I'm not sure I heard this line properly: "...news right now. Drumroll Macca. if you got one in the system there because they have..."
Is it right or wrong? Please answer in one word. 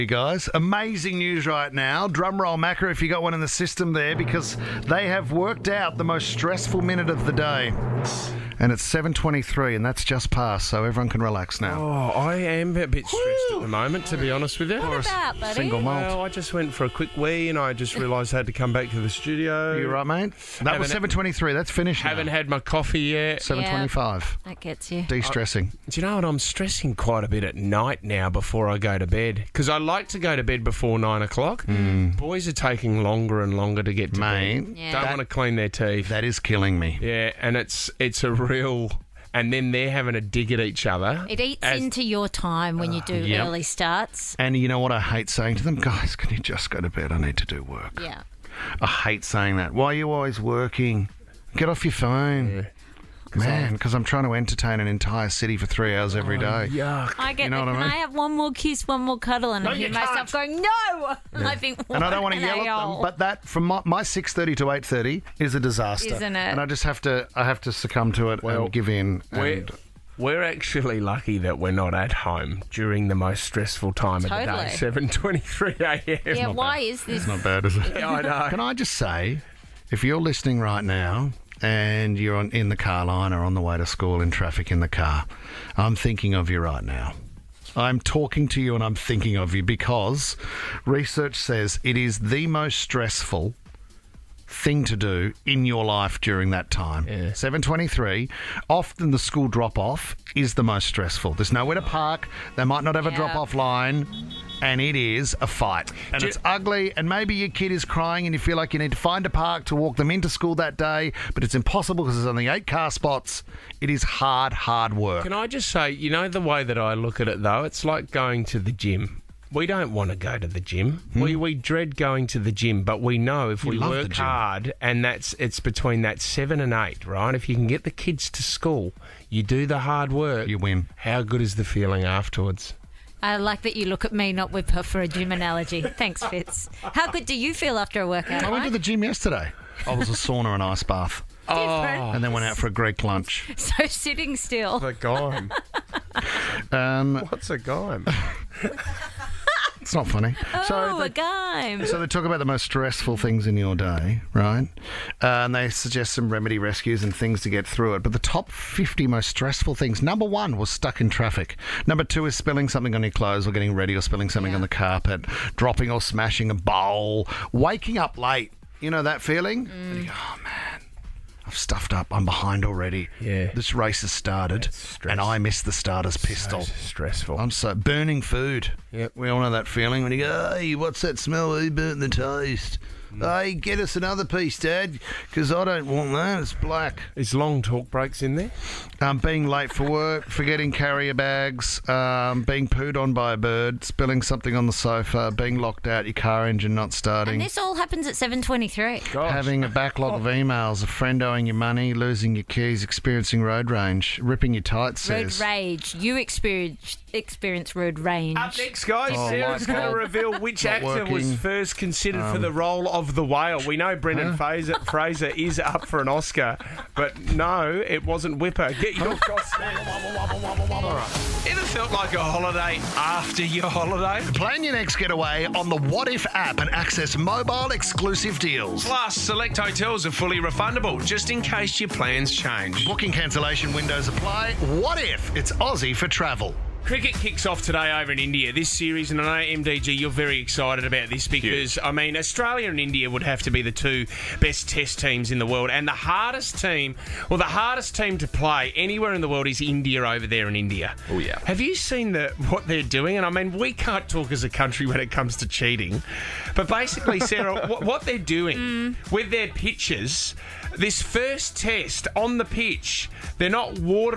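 right.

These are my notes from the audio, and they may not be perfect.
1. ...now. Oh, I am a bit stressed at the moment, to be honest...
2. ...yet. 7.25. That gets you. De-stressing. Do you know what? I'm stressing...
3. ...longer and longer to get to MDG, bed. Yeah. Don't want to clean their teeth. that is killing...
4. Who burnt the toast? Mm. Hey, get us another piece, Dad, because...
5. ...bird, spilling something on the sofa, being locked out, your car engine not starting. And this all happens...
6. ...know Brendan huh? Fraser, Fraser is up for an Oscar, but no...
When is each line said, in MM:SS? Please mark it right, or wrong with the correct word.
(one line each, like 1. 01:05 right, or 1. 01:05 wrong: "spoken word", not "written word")
1. 00:11 right
2. 00:22 right
3. 00:33 wrong: "Mate", not "MDG"
4. 03:01 right
5. 03:13 right
6. 03:33 right.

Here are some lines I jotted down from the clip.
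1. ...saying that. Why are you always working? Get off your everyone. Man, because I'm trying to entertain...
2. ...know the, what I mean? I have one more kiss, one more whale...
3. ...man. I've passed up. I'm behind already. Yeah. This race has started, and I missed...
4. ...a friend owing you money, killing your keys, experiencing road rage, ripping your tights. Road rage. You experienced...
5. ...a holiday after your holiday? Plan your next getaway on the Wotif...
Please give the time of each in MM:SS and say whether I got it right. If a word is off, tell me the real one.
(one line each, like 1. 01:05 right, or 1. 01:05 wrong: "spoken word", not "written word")
1. 00:49 wrong: "phone", not "everyone"
2. 00:57 wrong: "cuddle", not "whale"
3. 02:50 wrong: "stuffed", not "passed"
4. 03:20 wrong: "losing", not "killing"
5. 03:42 right.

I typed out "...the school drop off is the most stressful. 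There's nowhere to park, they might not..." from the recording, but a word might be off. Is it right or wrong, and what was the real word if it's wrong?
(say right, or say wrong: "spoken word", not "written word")
right.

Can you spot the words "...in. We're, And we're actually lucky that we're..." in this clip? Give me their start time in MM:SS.
01:08.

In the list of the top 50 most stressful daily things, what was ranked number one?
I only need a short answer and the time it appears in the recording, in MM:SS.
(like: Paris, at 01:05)
Stuck in traffic, at 02:40.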